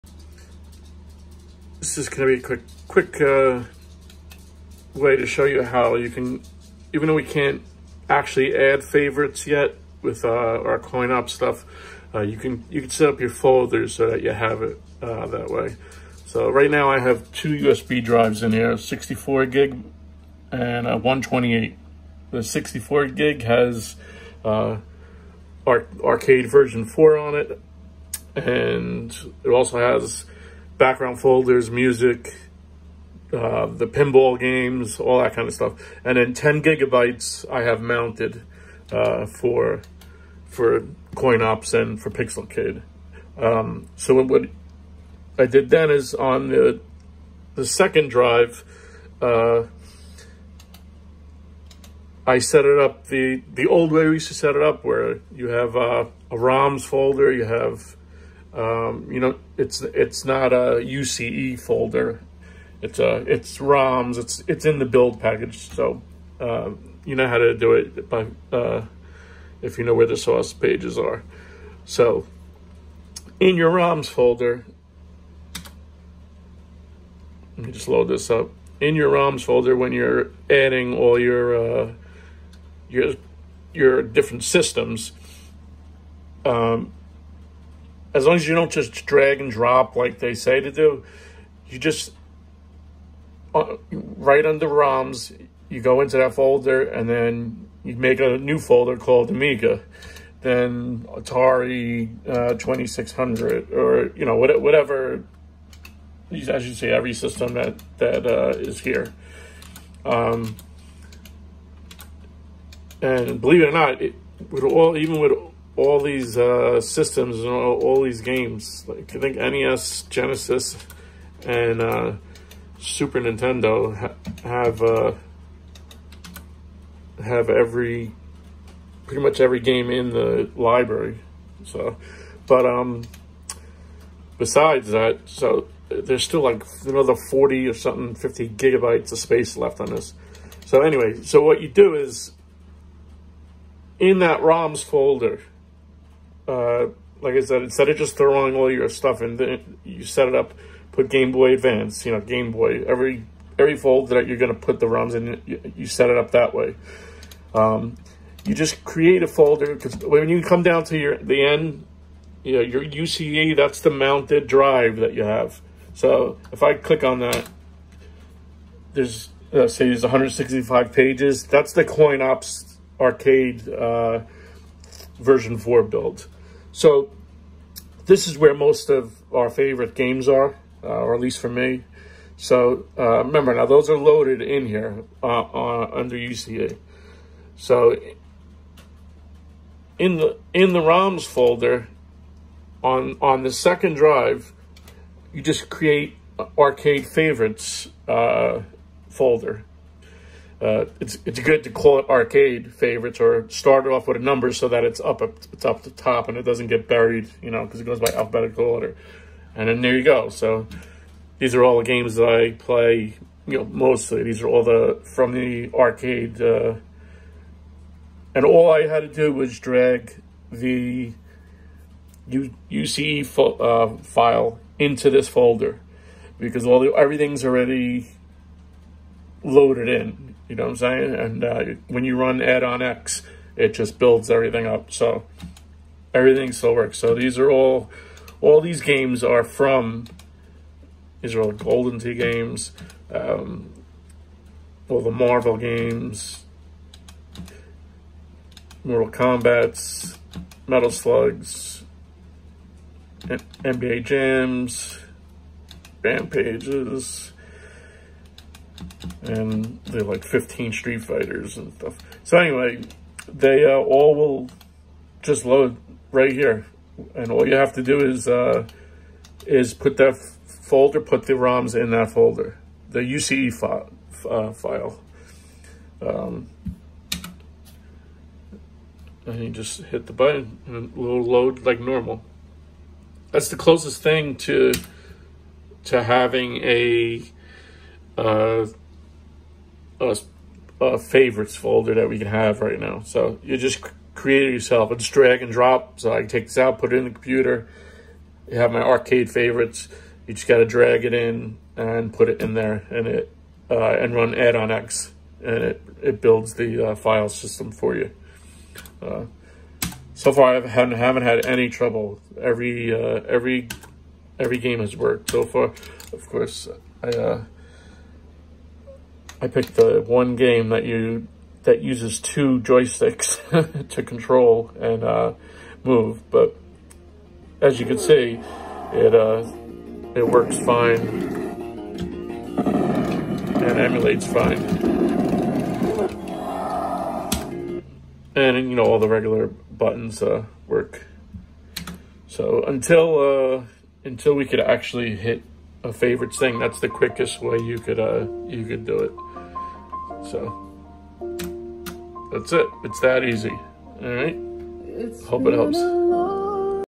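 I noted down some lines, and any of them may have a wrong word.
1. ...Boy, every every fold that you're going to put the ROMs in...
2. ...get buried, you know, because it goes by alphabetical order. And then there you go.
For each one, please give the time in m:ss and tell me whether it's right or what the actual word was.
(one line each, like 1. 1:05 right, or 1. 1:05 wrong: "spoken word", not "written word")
1. 2:32 right
2. 3:26 right.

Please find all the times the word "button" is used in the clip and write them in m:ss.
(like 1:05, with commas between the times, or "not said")
4:40, 5:39.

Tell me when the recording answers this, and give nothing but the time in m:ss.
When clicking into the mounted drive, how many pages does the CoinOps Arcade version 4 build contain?
2:50.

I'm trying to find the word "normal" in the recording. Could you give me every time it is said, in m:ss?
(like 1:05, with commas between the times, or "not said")
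4:41.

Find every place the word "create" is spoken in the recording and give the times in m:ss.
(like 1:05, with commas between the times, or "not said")
2:38, 3:15, 4:54.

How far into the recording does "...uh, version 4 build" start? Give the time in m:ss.
2:53.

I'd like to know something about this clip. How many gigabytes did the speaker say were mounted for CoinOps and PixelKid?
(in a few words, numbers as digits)
10 gigabytes.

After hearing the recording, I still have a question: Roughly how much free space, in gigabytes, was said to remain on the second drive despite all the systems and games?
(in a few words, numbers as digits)
50 gigabytes.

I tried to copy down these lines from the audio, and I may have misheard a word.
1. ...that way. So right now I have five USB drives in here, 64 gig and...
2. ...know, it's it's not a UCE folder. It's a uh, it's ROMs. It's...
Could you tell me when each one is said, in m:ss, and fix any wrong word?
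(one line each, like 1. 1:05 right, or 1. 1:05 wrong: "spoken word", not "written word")
1. 0:15 wrong: "two", not "five"
2. 0:59 right.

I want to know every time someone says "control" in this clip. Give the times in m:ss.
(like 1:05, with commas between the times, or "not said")
5:24.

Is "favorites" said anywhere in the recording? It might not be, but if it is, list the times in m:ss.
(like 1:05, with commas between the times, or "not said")
0:08, 2:59, 3:17, 3:22, 4:50, 4:59, 5:45.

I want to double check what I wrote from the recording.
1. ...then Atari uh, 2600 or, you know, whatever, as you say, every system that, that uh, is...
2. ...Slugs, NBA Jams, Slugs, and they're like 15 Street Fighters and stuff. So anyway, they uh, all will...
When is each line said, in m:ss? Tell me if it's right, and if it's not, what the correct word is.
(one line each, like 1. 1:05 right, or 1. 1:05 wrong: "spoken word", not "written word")
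1. 1:40 right
2. 4:10 wrong: "Rampages", not "Slugs".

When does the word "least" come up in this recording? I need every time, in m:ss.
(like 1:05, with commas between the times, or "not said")
3:01.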